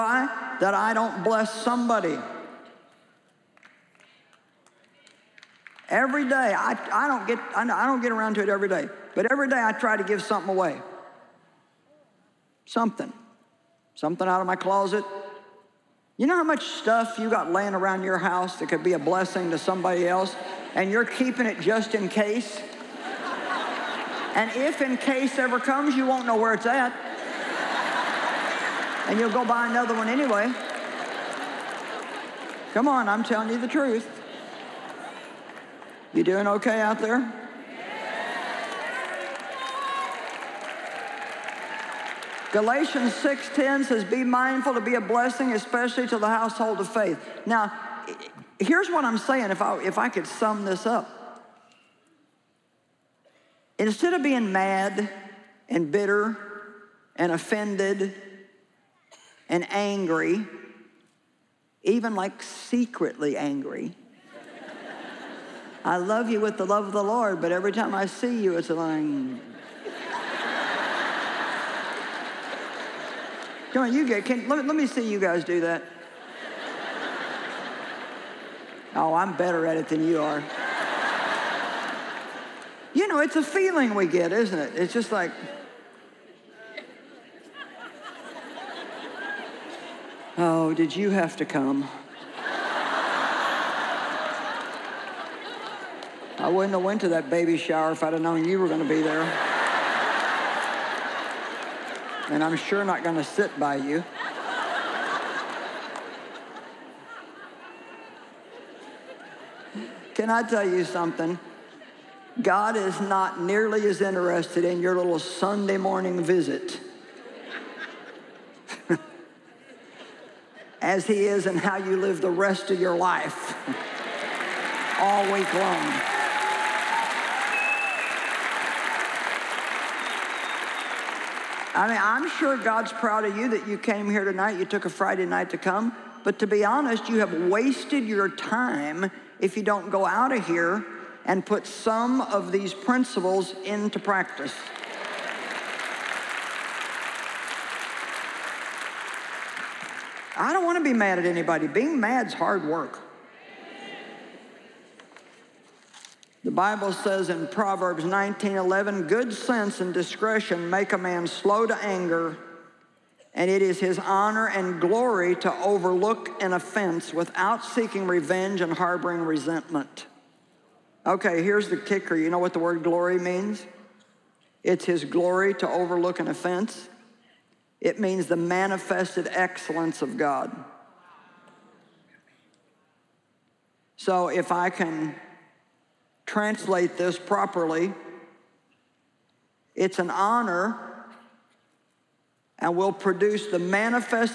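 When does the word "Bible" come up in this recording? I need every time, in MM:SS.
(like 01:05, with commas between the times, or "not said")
02:36.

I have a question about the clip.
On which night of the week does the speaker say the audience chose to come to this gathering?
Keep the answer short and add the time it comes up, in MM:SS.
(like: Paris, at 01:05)
Friday, at 02:14.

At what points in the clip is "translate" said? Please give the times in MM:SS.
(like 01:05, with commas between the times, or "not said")
03:06.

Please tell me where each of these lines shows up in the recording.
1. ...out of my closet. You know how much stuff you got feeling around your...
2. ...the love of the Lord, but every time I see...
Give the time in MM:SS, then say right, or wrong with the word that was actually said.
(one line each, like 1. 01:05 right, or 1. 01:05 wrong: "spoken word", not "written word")
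1. 00:14 wrong: "laying", not "feeling"
2. 01:06 right.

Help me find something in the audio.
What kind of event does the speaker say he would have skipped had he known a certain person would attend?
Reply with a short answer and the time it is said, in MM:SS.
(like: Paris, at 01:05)
baby shower, at 01:37.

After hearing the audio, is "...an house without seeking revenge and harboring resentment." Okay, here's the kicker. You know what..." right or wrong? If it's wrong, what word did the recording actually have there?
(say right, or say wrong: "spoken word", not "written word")
wrong: "offense", not "house".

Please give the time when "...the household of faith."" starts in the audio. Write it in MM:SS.
00:46.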